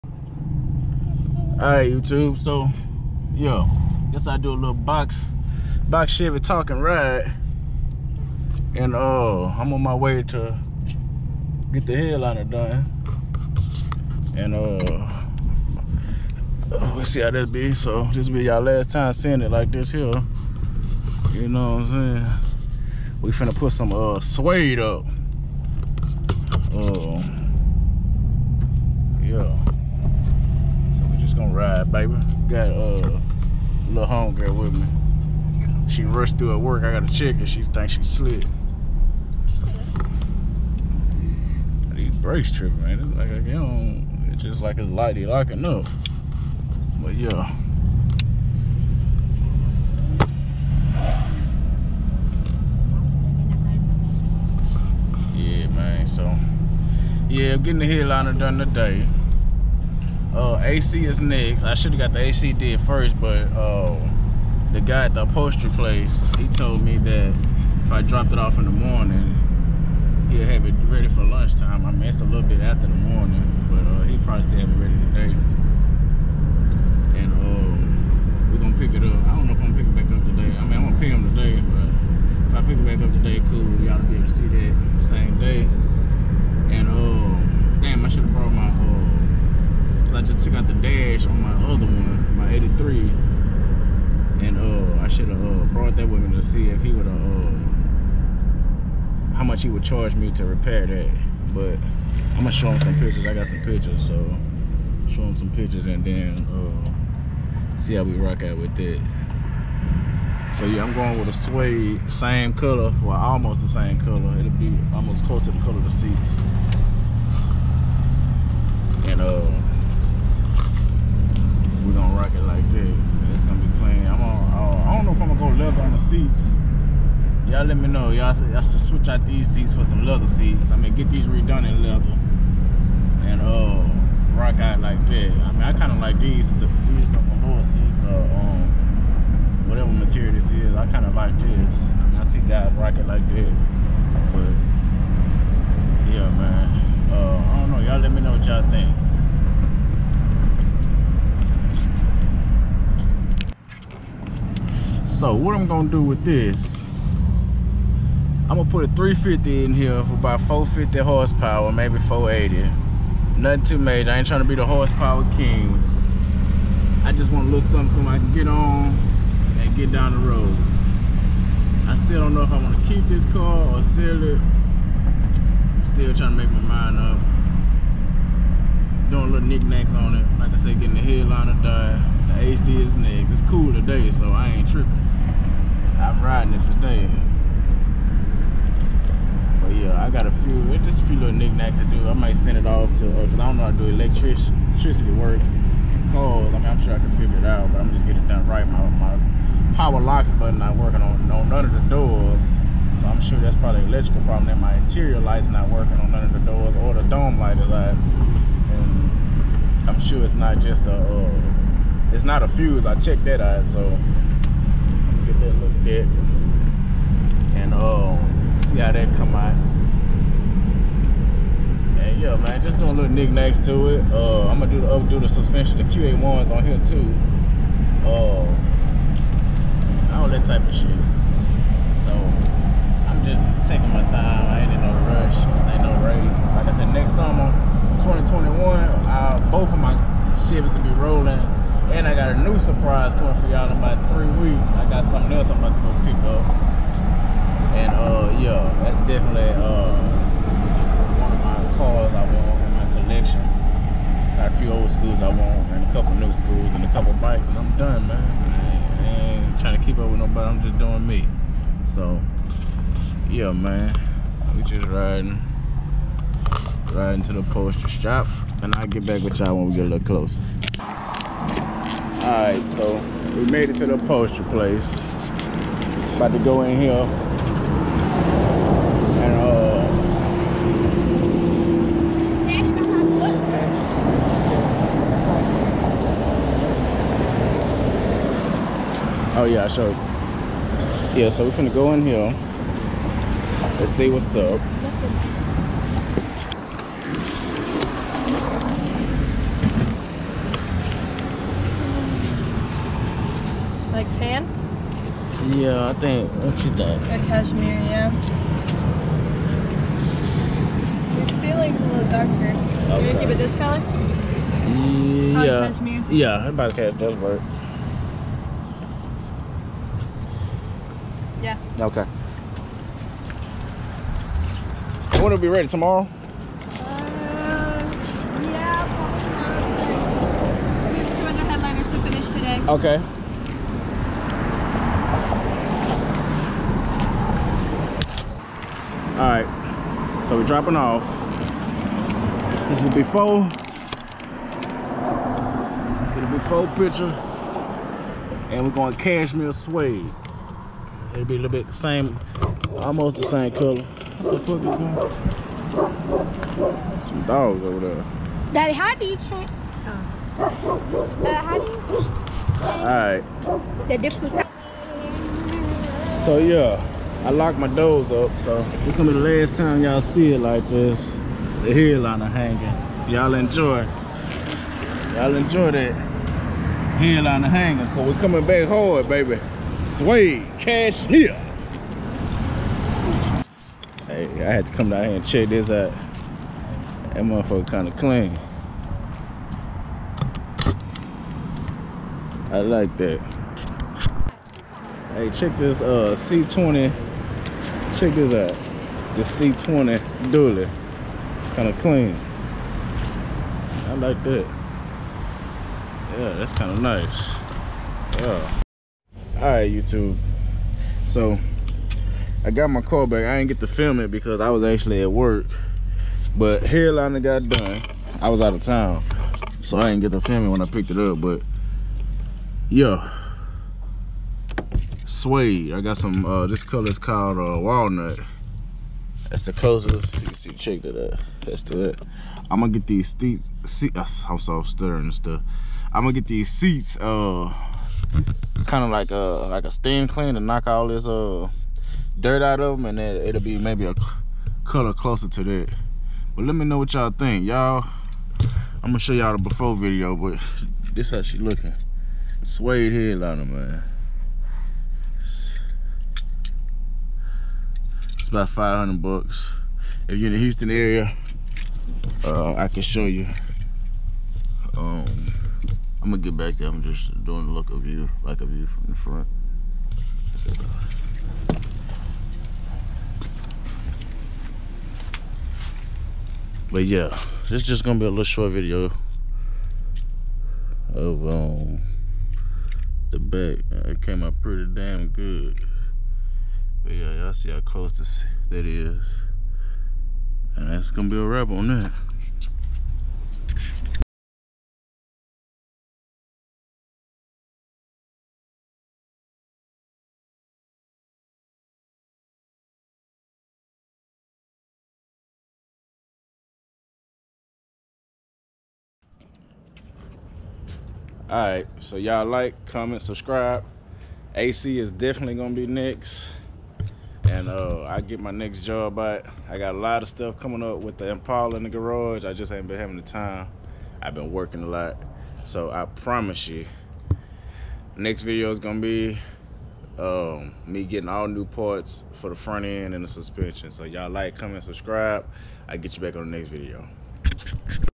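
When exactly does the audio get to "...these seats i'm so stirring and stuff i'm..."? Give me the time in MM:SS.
07:12.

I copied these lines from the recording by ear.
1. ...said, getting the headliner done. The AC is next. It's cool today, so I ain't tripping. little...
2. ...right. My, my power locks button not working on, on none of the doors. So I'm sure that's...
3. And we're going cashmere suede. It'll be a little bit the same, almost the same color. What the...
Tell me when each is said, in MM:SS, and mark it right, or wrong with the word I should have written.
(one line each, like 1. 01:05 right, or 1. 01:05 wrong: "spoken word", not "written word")
1. 03:00 right
2. 03:18 right
3. 05:48 right.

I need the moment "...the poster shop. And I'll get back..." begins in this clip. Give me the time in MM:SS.
04:27.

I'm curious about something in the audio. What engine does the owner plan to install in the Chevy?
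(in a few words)
350.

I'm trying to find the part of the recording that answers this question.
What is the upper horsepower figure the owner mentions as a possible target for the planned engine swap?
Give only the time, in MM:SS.
02:41.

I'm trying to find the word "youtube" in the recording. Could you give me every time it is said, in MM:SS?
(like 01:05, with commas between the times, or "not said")
00:01, 06:49.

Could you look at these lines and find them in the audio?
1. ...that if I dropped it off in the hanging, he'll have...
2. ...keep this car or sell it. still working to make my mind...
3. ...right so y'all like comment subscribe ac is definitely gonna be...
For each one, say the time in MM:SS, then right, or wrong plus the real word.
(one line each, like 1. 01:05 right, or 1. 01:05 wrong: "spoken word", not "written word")
1. 01:06 wrong: "morning", not "hanging"
2. 02:52 wrong: "trying", not "working"
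3. 08:31 right.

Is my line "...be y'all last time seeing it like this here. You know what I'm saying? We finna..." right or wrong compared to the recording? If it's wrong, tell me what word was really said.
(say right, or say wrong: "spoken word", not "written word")
right.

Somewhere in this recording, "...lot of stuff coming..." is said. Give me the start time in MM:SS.
08:39.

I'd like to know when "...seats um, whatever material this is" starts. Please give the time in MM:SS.
02:17.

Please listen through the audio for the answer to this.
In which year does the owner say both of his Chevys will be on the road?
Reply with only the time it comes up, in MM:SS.
03:58.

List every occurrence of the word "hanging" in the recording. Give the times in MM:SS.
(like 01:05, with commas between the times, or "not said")
06:12, 06:17.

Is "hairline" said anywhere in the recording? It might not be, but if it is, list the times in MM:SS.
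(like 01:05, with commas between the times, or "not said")
06:56.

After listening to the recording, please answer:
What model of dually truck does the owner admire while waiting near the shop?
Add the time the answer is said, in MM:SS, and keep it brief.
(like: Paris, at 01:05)
C20, at 06:39.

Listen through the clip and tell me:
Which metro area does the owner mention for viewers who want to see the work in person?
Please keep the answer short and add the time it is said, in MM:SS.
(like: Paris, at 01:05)
Houston, at 07:40.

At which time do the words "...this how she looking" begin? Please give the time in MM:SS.
07:30.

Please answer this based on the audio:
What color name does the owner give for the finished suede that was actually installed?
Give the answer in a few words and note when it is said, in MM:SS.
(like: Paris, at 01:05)
Walnut, at 07:07.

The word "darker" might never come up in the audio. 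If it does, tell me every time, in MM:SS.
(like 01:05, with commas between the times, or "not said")
05:12.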